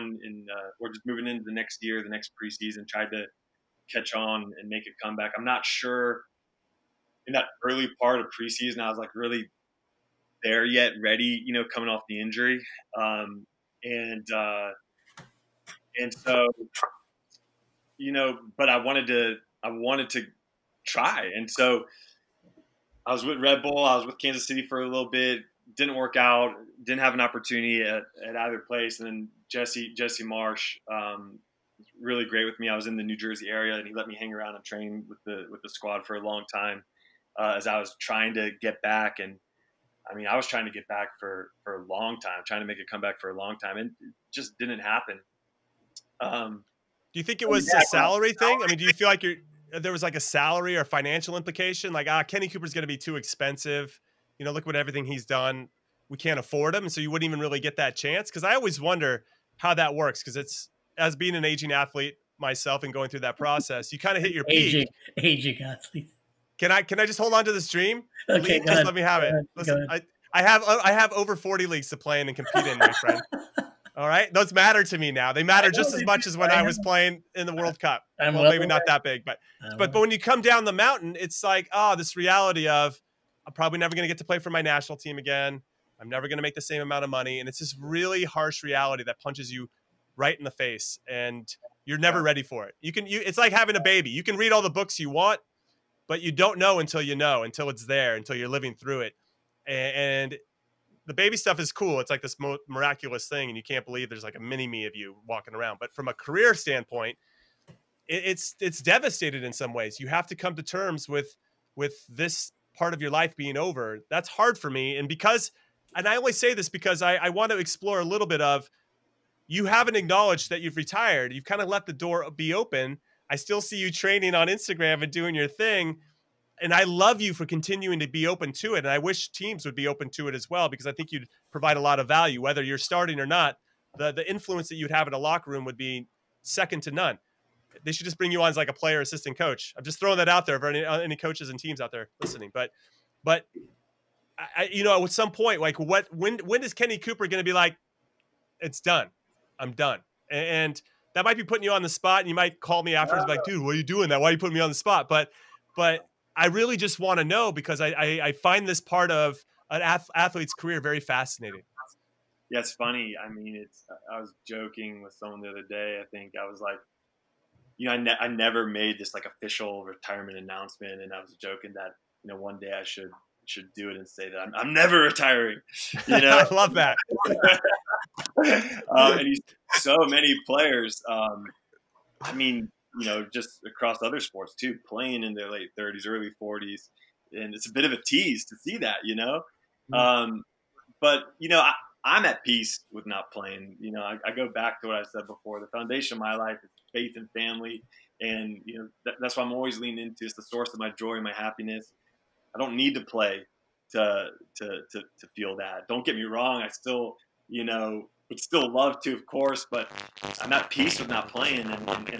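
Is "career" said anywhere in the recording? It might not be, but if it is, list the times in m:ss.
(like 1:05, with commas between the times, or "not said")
1:46, 2:40.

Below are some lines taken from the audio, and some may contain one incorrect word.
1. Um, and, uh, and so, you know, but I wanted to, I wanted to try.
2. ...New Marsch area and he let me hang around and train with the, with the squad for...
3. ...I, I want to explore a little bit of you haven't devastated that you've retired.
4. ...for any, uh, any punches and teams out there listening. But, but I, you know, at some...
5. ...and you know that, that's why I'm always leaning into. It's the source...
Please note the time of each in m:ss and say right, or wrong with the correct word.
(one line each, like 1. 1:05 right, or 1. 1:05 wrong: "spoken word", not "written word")
1. 0:12 right
2. 0:33 wrong: "Jersey", not "Marsch"
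3. 1:56 wrong: "acknowledged", not "devastated"
4. 2:20 wrong: "coaches", not "punches"
5. 3:18 right.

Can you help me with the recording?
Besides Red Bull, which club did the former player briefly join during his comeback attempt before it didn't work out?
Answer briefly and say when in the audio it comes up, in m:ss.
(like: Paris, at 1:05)
Kansas City, at 0:24.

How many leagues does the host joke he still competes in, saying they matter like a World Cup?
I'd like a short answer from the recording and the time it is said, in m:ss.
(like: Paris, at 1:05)
over 40, at 1:11.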